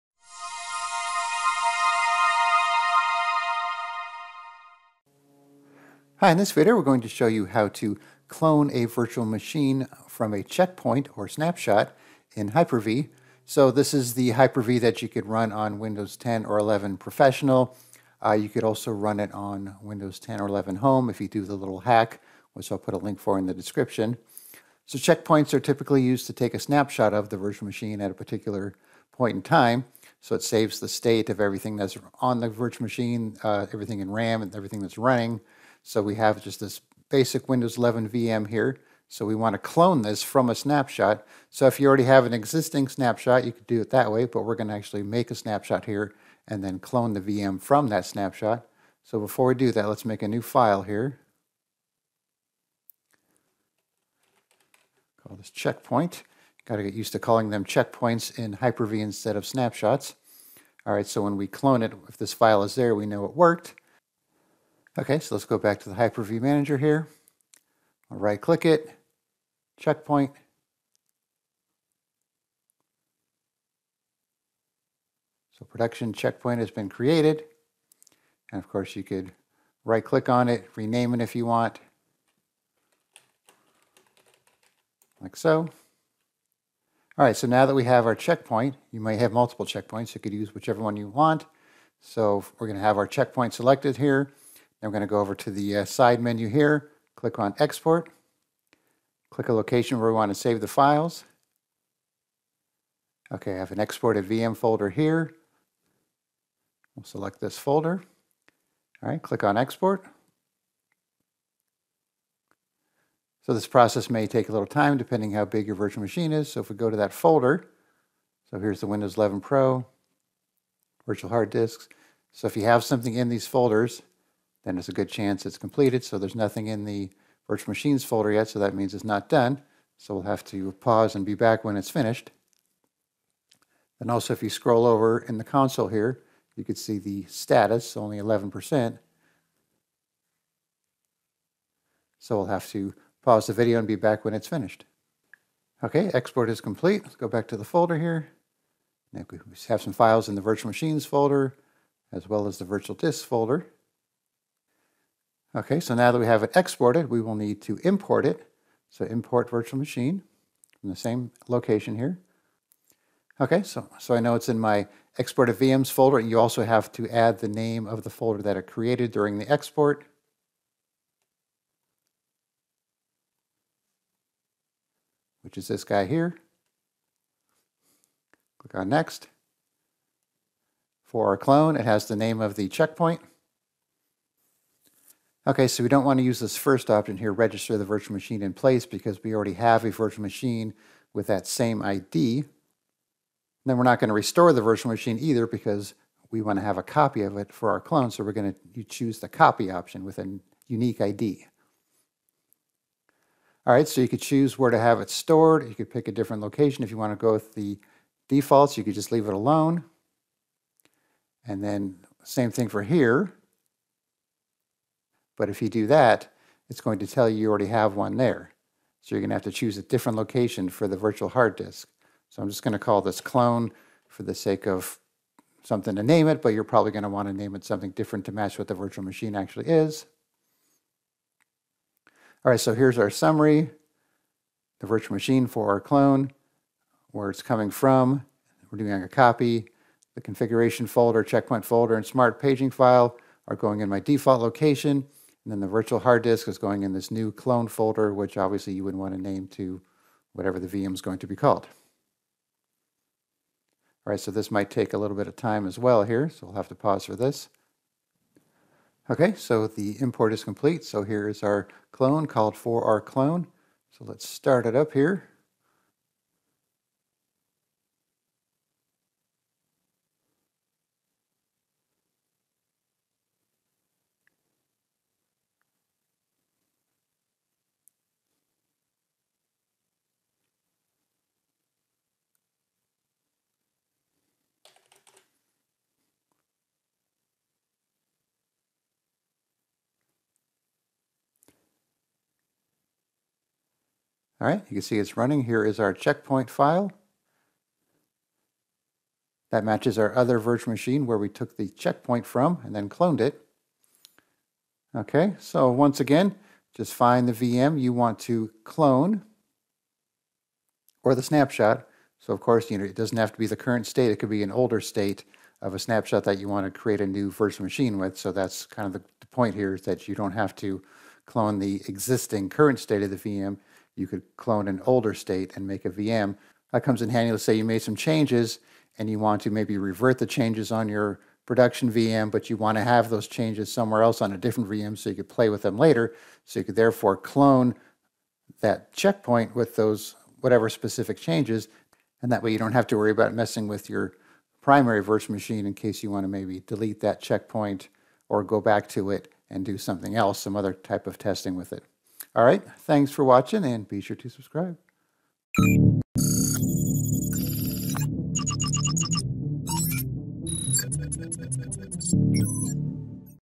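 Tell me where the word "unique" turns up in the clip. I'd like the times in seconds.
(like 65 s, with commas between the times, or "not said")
200 s.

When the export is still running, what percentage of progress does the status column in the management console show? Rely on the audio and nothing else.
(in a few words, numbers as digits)
11%.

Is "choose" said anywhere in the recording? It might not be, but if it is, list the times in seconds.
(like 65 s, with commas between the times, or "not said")
198 s, 204 s, 219 s.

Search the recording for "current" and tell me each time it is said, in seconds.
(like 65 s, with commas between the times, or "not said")
313 s, 322 s.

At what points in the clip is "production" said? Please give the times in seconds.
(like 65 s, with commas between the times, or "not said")
75 s, 331 s.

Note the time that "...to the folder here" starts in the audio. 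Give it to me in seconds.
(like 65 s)
147 s.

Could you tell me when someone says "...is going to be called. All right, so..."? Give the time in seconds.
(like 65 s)
250 s.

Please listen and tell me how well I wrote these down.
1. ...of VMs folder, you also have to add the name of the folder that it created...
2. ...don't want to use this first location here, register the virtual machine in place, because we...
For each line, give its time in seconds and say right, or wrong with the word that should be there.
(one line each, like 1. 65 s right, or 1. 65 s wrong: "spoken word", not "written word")
1. 165 s right
2. 185 s wrong: "option", not "location".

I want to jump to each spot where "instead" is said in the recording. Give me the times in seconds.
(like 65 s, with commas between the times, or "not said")
59 s.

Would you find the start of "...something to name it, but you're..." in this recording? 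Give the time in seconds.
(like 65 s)
225 s.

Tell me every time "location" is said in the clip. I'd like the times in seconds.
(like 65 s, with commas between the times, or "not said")
99 s, 161 s, 206 s, 220 s, 244 s.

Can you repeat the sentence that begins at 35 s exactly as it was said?
So we have just this basic Windows 11 VM here.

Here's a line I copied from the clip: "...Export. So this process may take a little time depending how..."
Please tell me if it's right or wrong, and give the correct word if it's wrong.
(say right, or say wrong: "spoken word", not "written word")
right.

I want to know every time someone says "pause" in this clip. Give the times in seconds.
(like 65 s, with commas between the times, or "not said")
130 s, 143 s, 256 s.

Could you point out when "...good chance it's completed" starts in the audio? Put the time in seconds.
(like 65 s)
124 s.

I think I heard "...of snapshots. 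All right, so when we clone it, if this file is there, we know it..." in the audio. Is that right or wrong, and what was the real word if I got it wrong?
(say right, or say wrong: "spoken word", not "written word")
right.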